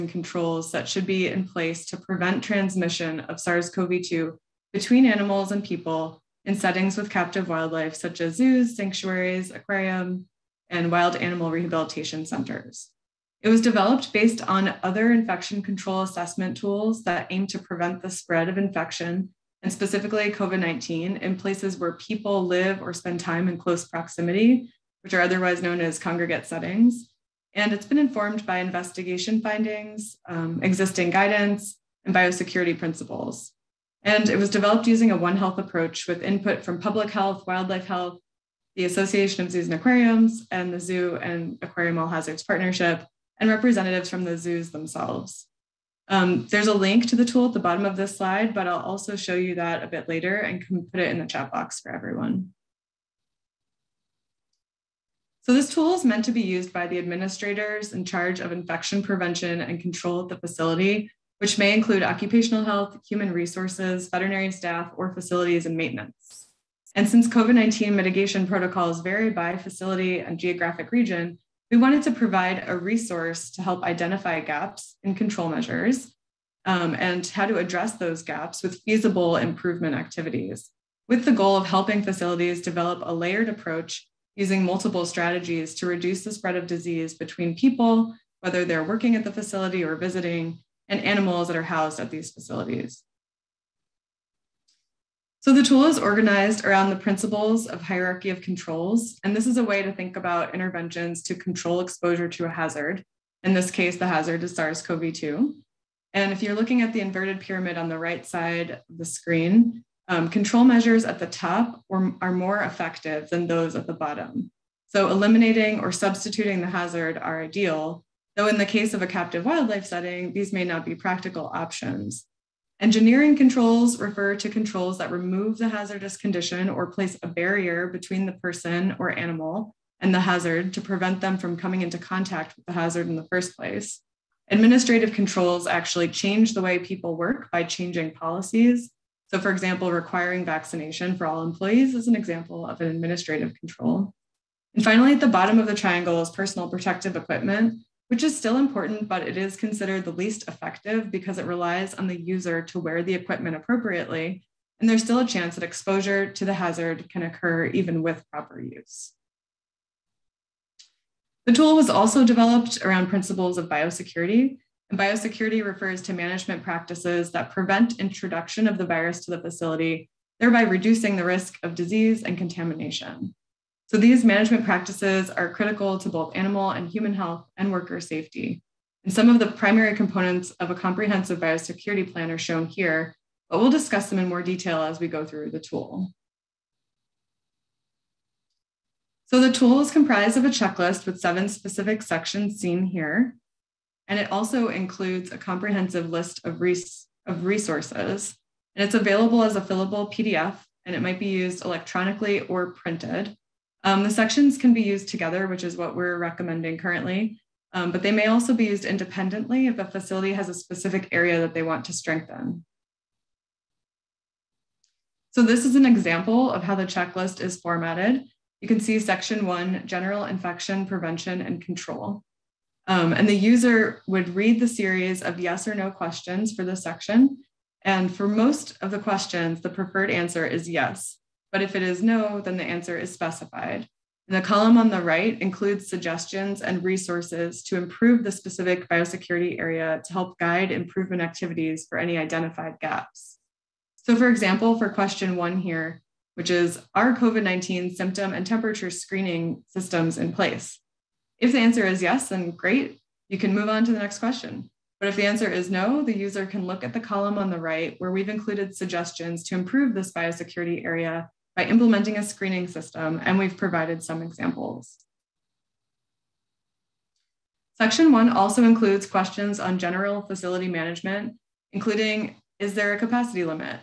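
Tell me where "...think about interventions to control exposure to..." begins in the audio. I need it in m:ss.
1:39.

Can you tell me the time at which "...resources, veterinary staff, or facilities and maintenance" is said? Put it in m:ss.
1:03.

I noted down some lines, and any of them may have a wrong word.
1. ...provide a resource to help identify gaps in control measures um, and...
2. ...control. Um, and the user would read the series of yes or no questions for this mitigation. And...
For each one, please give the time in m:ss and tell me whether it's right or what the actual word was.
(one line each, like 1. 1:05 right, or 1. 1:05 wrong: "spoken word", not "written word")
1. 1:12 right
2. 3:41 wrong: "section", not "mitigation".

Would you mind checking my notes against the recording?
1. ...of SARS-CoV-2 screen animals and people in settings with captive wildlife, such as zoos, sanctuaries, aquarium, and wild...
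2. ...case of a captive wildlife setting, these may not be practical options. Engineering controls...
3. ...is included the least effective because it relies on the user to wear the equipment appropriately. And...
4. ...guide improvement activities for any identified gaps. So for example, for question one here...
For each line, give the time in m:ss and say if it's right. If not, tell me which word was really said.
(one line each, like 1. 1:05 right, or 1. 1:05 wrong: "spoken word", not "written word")
1. 0:03 wrong: "between", not "screen"
2. 1:58 right
3. 2:29 wrong: "considered", not "included"
4. 4:00 right.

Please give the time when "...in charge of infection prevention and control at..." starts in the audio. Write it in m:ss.
0:57.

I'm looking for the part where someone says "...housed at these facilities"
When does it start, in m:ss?
1:31.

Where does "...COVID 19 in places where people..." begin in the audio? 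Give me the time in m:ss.
0:20.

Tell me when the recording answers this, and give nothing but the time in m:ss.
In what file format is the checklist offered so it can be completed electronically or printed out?
3:19.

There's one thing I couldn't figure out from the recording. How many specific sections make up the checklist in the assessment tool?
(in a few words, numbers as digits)
7.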